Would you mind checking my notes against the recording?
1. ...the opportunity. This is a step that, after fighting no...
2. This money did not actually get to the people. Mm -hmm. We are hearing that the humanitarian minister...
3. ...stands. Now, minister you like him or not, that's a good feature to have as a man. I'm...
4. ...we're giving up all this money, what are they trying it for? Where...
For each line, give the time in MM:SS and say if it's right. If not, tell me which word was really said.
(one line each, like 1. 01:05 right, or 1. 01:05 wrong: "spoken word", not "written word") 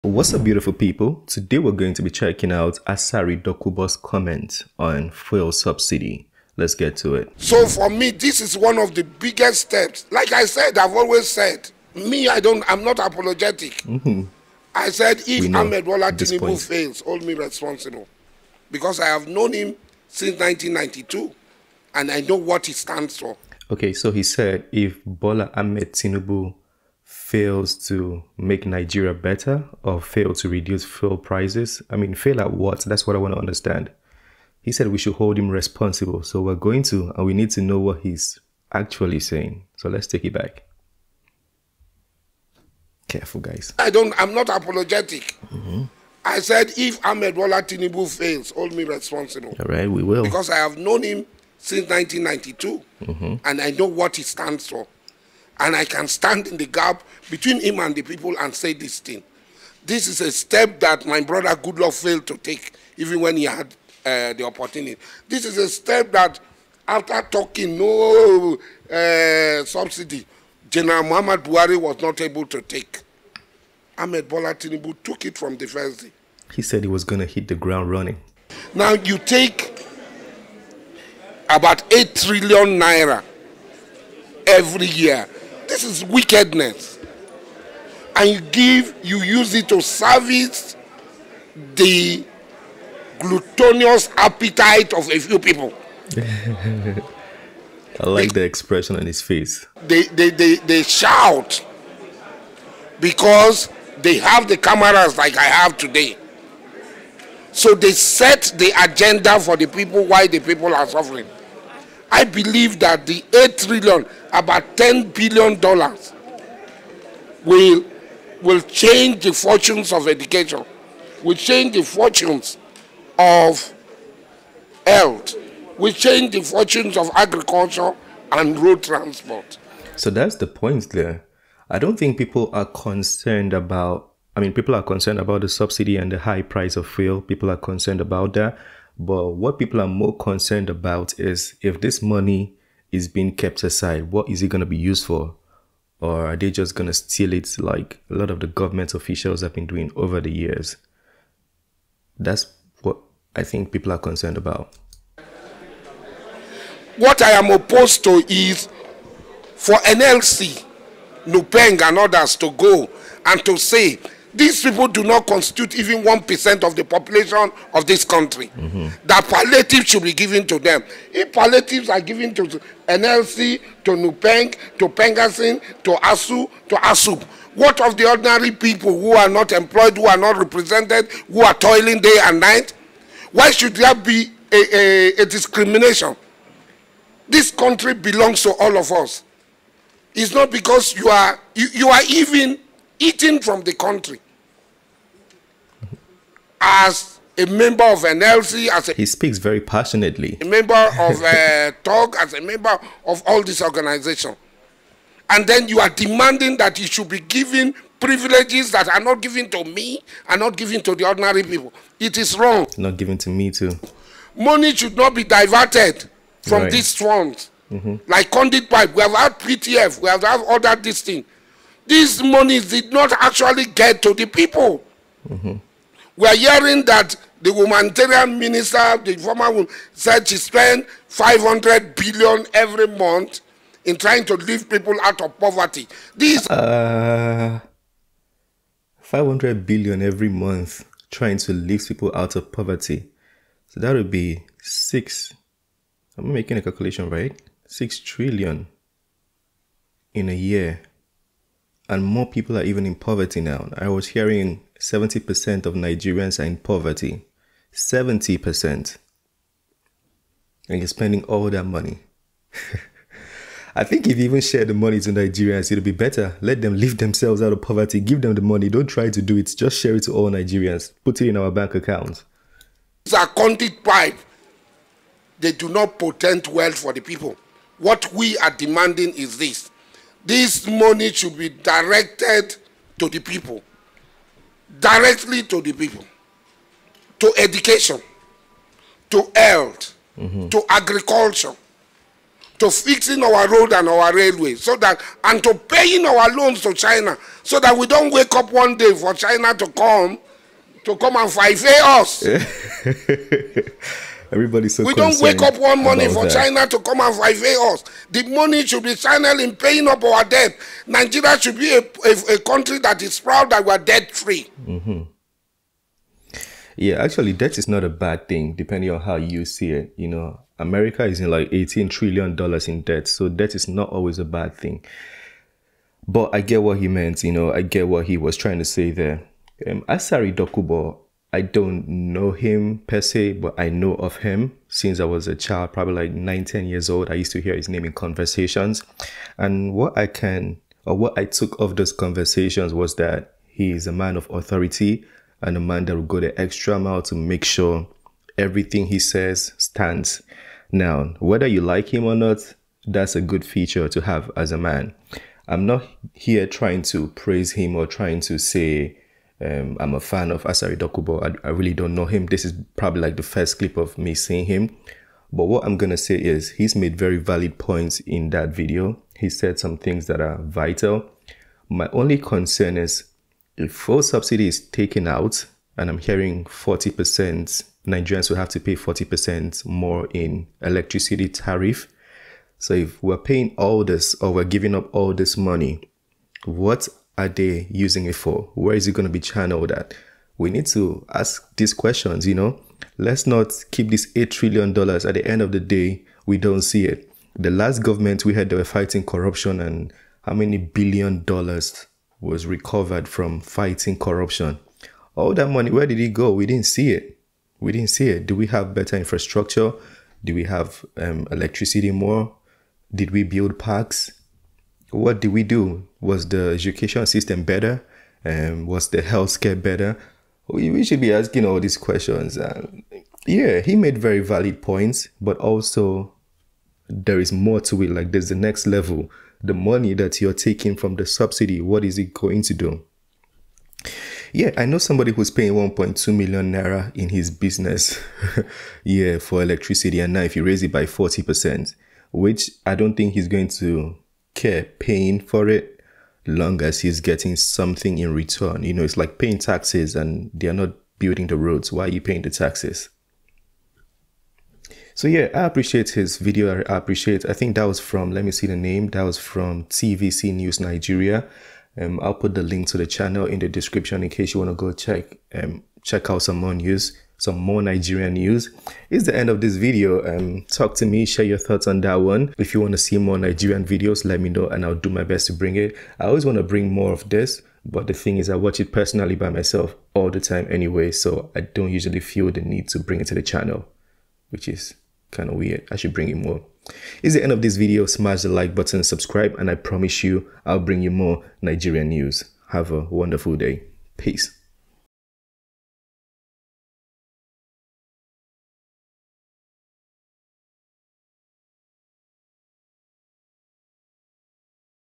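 1. 01:04 wrong: "talking", not "fighting"
2. 03:41 right
3. 05:49 wrong: "whether", not "minister"
4. 06:24 wrong: "using", not "trying".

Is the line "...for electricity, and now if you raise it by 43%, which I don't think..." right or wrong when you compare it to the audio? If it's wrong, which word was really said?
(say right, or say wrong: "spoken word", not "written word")
wrong: "40", not "43".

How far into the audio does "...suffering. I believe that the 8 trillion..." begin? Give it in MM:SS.
01:50.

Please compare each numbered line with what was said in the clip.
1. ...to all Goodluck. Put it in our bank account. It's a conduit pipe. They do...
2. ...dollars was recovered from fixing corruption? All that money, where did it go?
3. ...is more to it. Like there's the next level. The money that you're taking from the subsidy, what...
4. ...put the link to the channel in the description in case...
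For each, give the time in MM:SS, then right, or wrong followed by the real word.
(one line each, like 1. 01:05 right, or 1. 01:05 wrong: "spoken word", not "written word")
1. 04:30 wrong: "Nigerians", not "Goodluck"
2. 06:41 wrong: "fighting", not "fixing"
3. 07:07 right
4. 07:42 right.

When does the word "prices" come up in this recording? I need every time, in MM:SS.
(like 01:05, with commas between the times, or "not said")
00:31, 02:16.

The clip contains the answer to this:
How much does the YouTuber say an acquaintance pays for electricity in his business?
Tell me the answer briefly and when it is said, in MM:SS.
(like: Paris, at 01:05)
1.2 million naira, at 07:15.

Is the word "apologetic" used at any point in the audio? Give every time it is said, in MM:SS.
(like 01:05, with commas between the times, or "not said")
00:12, 00:44.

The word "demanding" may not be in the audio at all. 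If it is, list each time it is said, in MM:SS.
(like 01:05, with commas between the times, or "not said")
03:25, 04:38.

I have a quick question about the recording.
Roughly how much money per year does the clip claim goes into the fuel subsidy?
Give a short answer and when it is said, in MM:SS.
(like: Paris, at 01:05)
8 trillion naira, at 01:21.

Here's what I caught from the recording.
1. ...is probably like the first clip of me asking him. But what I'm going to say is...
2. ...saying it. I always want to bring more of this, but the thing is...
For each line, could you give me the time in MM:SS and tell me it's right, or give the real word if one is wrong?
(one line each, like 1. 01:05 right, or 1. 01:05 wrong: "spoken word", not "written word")
1. 06:02 wrong: "seeing", not "asking"
2. 07:55 wrong: "bring", not "saying".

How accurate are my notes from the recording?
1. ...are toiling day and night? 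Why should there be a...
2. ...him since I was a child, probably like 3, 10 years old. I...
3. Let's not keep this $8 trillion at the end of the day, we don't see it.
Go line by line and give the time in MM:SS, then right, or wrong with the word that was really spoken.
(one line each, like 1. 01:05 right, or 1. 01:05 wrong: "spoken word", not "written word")
1. 03:01 right
2. 05:34 wrong: "9", not "3"
3. 06:32 right.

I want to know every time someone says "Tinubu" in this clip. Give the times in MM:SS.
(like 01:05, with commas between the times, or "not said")
00:16, 00:25, 00:47, 01:14.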